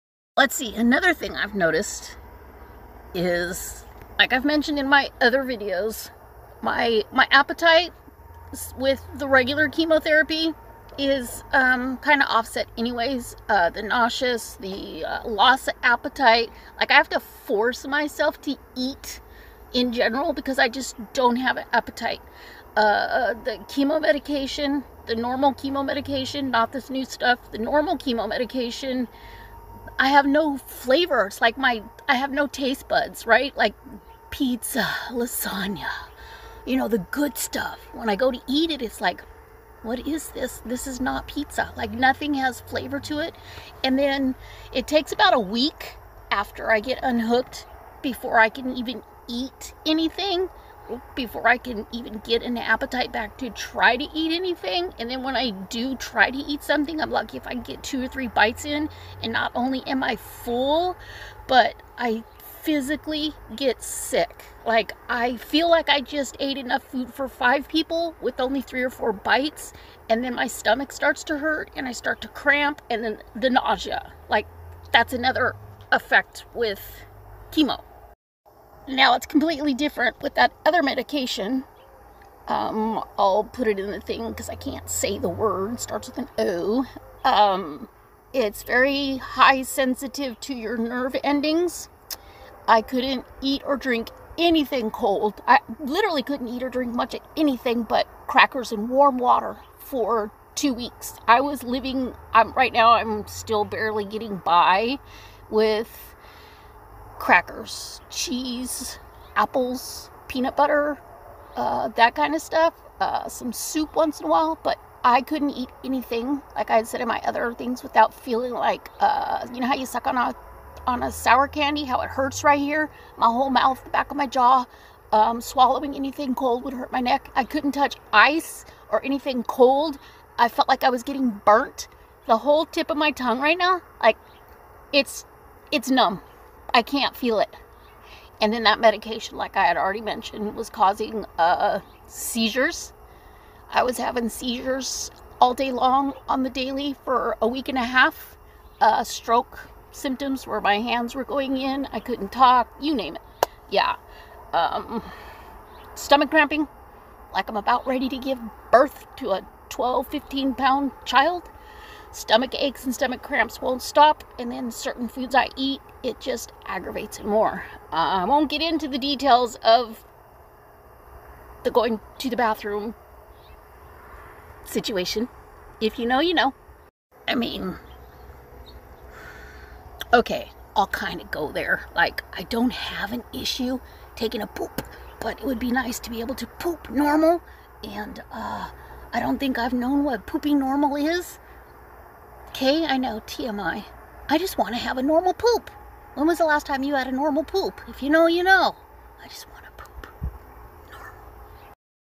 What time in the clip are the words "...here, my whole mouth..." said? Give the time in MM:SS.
02:02.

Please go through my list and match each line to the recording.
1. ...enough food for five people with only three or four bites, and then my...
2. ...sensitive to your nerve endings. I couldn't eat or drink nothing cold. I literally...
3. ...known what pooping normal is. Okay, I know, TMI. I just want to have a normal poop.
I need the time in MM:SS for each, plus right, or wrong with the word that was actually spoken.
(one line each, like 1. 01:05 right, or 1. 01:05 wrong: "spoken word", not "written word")
1. 01:06 right
2. 01:29 wrong: "anything", not "nothing"
3. 03:09 right.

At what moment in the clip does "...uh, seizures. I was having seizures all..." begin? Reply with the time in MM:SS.
02:21.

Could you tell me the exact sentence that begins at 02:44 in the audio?
And then certain foods I eat, it just aggravates it more.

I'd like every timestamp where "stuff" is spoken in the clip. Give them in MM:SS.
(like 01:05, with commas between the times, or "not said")
00:27, 00:37, 01:52.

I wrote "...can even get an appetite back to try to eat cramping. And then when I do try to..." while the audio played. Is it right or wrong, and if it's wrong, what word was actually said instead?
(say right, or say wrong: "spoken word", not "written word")
wrong: "anything", not "cramping".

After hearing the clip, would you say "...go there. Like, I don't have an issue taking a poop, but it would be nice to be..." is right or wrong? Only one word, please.
right.